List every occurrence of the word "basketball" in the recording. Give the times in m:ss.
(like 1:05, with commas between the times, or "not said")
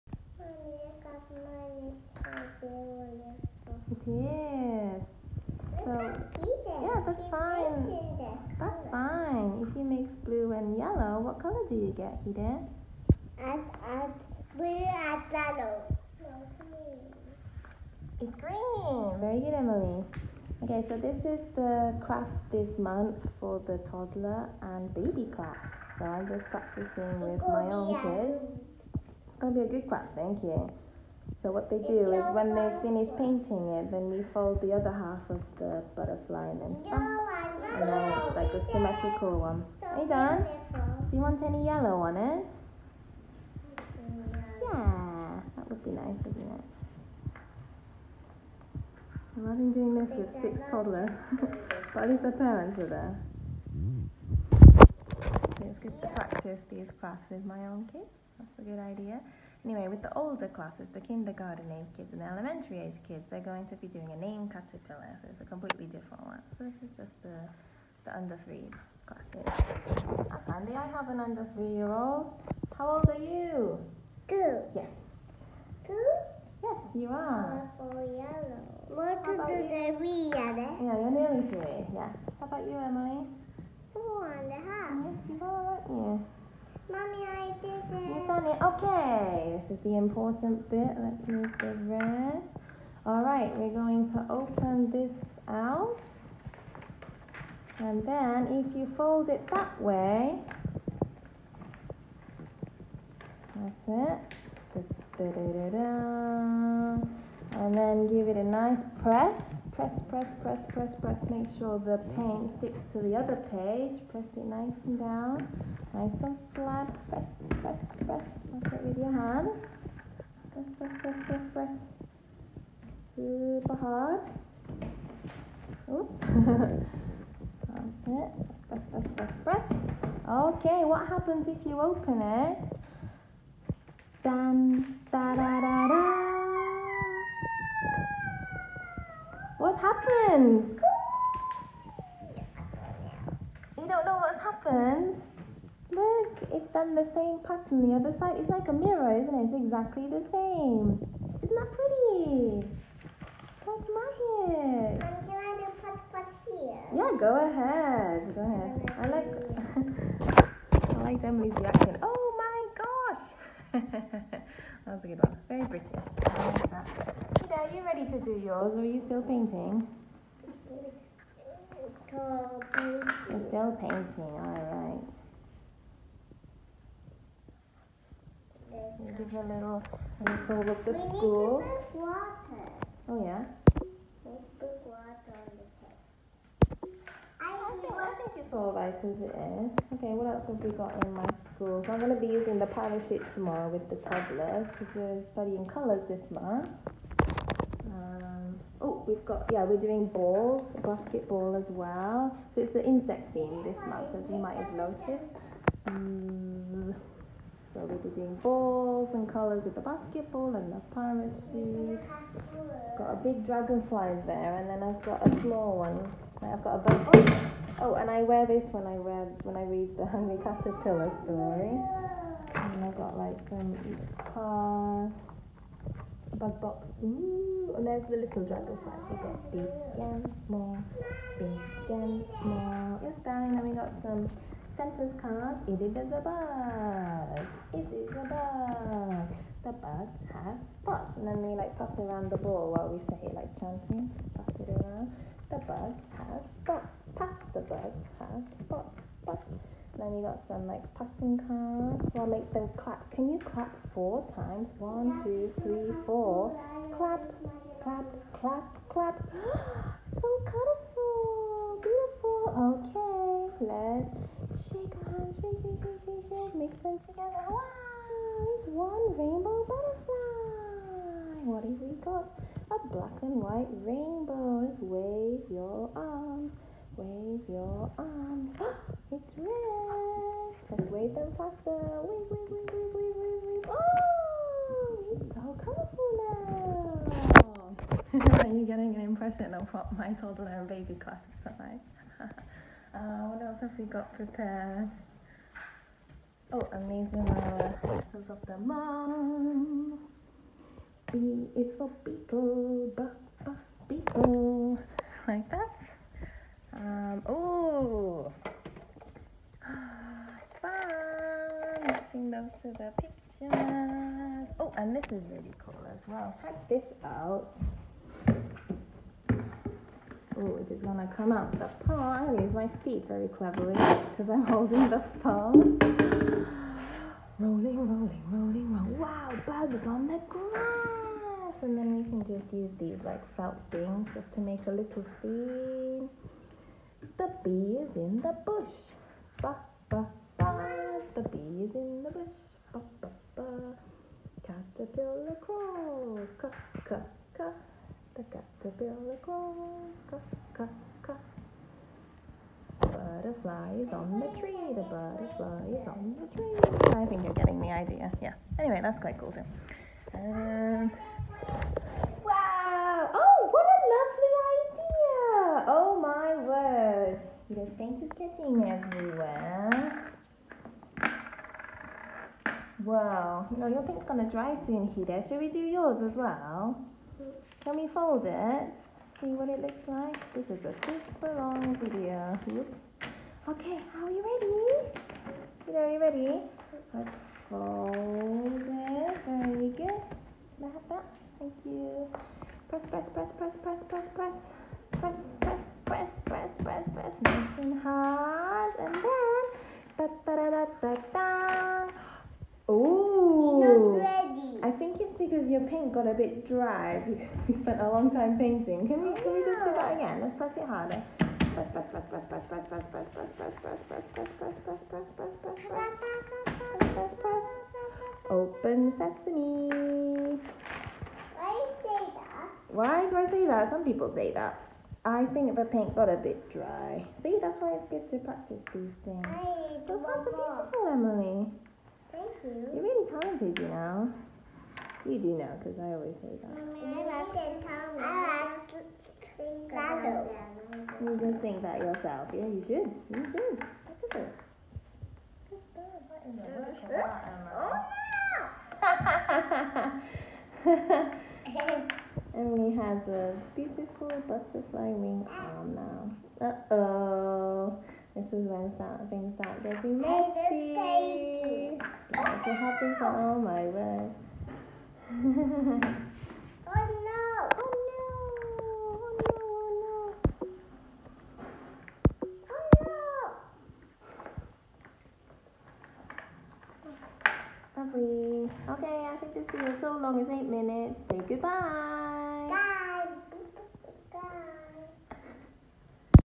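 3:20, 3:29.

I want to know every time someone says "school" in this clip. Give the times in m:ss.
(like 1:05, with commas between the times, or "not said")
3:01, 3:11.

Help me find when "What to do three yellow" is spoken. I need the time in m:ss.
1:18.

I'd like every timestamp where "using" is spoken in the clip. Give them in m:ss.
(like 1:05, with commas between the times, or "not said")
3:12.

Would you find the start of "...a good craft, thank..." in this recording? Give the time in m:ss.
0:29.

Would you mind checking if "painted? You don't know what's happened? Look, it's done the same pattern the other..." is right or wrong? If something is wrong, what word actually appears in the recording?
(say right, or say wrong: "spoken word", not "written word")
wrong: "happened", not "painted".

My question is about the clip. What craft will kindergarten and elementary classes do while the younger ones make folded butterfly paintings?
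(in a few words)
Name caterpillar.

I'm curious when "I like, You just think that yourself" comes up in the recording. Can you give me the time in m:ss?
7:18.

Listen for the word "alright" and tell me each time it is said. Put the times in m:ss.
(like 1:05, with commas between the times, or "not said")
2:54, 3:08.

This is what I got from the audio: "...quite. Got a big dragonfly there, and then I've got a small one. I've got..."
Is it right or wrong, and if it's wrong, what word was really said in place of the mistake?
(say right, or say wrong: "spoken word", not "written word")
wrong: "parachute", not "quite".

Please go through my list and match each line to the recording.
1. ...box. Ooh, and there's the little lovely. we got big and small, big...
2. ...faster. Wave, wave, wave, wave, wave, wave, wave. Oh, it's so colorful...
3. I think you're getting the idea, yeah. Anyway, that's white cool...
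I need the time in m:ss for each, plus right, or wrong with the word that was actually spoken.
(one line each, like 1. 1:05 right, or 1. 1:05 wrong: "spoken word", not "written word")
1. 3:46 wrong: "dragonfly", not "lovely"
2. 4:41 right
3. 5:56 wrong: "quite", not "white".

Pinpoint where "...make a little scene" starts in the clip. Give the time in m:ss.
5:34.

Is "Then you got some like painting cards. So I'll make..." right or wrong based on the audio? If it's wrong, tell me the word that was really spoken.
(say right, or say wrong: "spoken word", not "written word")
wrong: "passing", not "painting".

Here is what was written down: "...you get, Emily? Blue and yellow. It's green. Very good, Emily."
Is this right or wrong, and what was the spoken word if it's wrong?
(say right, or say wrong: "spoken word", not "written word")
wrong: "Hiden", not "Emily".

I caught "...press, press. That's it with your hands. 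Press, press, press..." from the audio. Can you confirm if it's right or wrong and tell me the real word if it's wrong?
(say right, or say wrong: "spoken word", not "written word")
right.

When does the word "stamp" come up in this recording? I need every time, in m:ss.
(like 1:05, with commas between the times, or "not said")
0:36.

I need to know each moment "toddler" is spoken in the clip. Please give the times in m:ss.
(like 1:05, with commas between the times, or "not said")
0:23, 0:50, 3:14, 4:50.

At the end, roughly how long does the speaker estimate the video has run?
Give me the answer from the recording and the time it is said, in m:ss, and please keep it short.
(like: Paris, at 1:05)
8 minutes, at 8:00.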